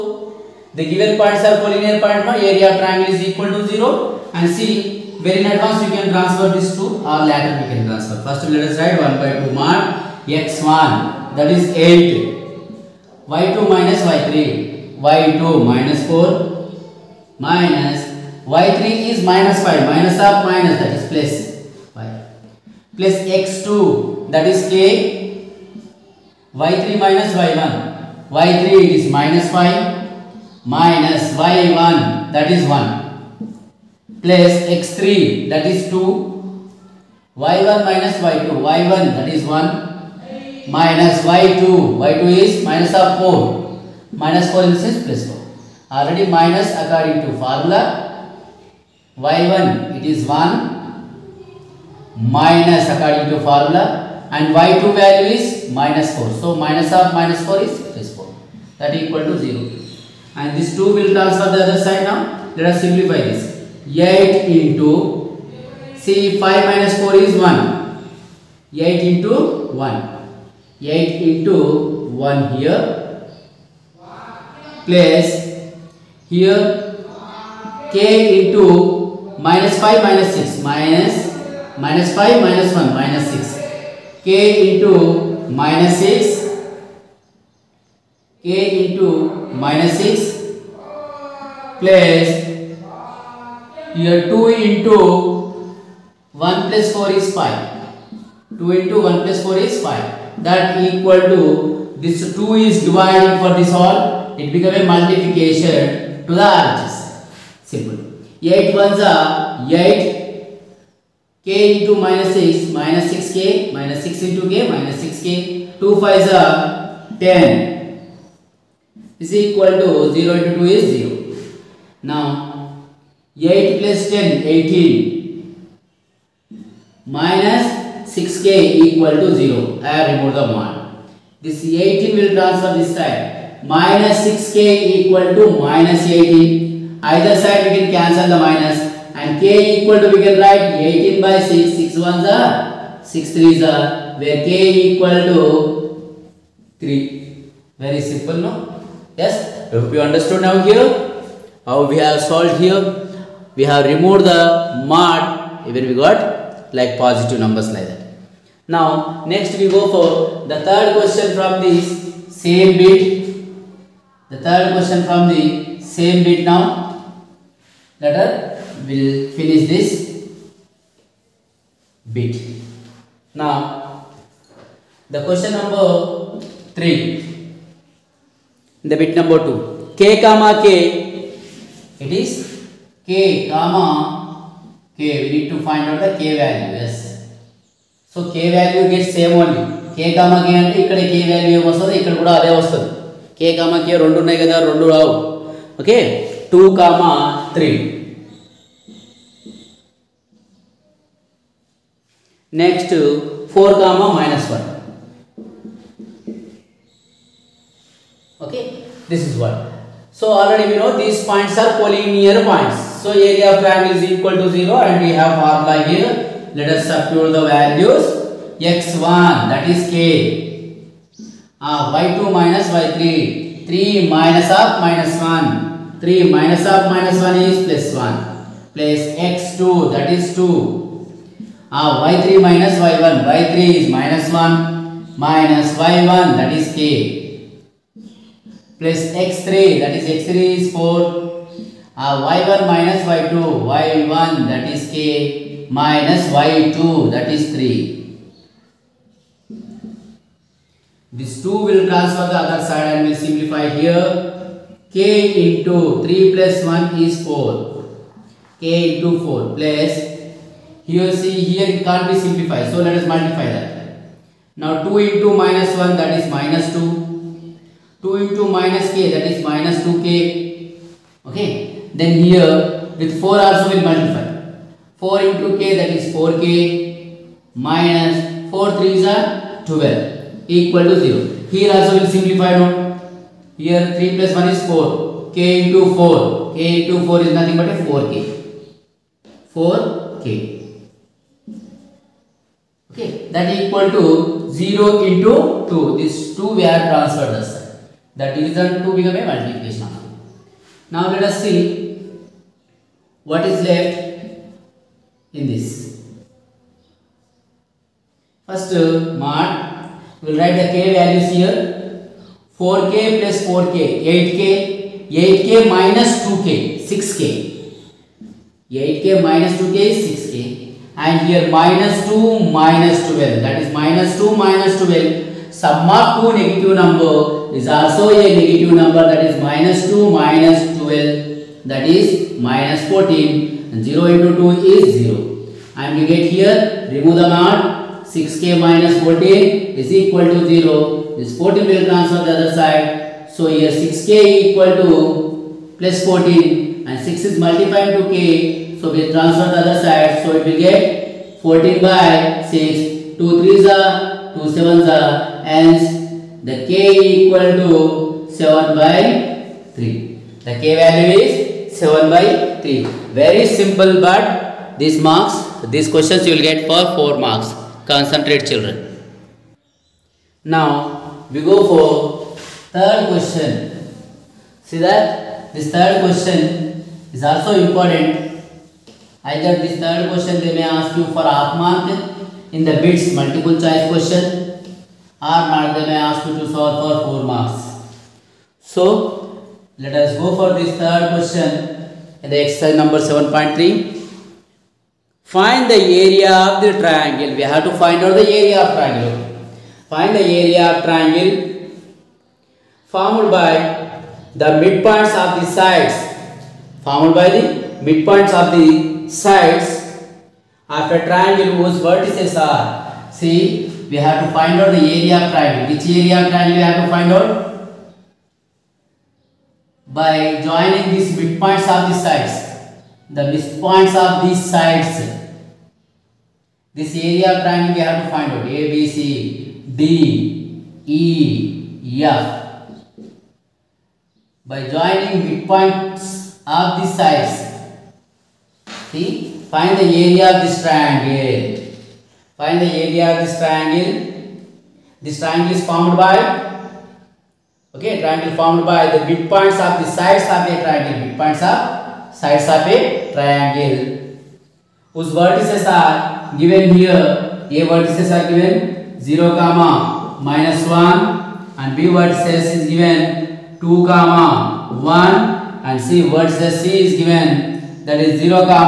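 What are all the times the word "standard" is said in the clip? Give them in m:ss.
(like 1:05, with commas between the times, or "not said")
not said.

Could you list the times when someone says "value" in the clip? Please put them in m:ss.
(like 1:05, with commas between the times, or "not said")
0:54, 3:06, 3:37, 5:10, 6:00.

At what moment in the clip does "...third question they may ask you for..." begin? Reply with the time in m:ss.
6:19.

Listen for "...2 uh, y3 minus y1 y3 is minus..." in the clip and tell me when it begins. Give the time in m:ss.
3:50.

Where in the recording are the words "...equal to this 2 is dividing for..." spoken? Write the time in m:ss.
1:40.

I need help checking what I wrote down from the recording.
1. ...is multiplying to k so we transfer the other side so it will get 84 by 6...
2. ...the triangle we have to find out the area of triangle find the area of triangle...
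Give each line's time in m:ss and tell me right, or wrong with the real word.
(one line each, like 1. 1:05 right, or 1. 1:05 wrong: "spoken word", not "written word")
1. 5:47 wrong: "14", not "84"
2. 6:36 right.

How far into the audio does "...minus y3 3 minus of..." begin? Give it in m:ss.
3:42.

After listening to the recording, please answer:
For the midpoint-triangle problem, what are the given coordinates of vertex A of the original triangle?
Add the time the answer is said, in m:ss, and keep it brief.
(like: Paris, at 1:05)
(0, -1), at 7:39.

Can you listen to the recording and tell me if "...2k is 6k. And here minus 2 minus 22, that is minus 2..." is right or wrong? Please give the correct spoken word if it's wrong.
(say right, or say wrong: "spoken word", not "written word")
wrong: "12", not "22".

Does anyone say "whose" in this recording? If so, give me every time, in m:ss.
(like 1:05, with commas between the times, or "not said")
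6:51, 7:34.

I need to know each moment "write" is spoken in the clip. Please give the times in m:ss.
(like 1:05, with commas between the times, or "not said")
0:08, 2:20, 5:10.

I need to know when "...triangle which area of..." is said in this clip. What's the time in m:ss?
6:55.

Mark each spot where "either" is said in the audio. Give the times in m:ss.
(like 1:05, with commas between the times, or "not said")
2:17, 6:19.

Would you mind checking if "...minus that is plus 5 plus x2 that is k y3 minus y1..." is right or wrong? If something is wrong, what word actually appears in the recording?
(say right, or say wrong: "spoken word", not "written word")
right.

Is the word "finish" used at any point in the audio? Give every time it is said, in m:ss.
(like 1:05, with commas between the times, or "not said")
2:49.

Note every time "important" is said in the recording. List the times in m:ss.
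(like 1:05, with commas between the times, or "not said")
6:17.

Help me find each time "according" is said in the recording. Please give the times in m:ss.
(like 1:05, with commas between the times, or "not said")
0:46, 0:52.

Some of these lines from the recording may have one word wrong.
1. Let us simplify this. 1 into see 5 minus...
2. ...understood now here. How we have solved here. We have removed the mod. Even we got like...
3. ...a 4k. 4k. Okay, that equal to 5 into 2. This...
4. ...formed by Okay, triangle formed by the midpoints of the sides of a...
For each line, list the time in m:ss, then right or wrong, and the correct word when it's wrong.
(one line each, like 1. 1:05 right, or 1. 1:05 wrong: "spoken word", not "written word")
1. 1:02 wrong: "8", not "1"
2. 2:30 right
3. 4:47 wrong: "0", not "5"
4. 7:25 right.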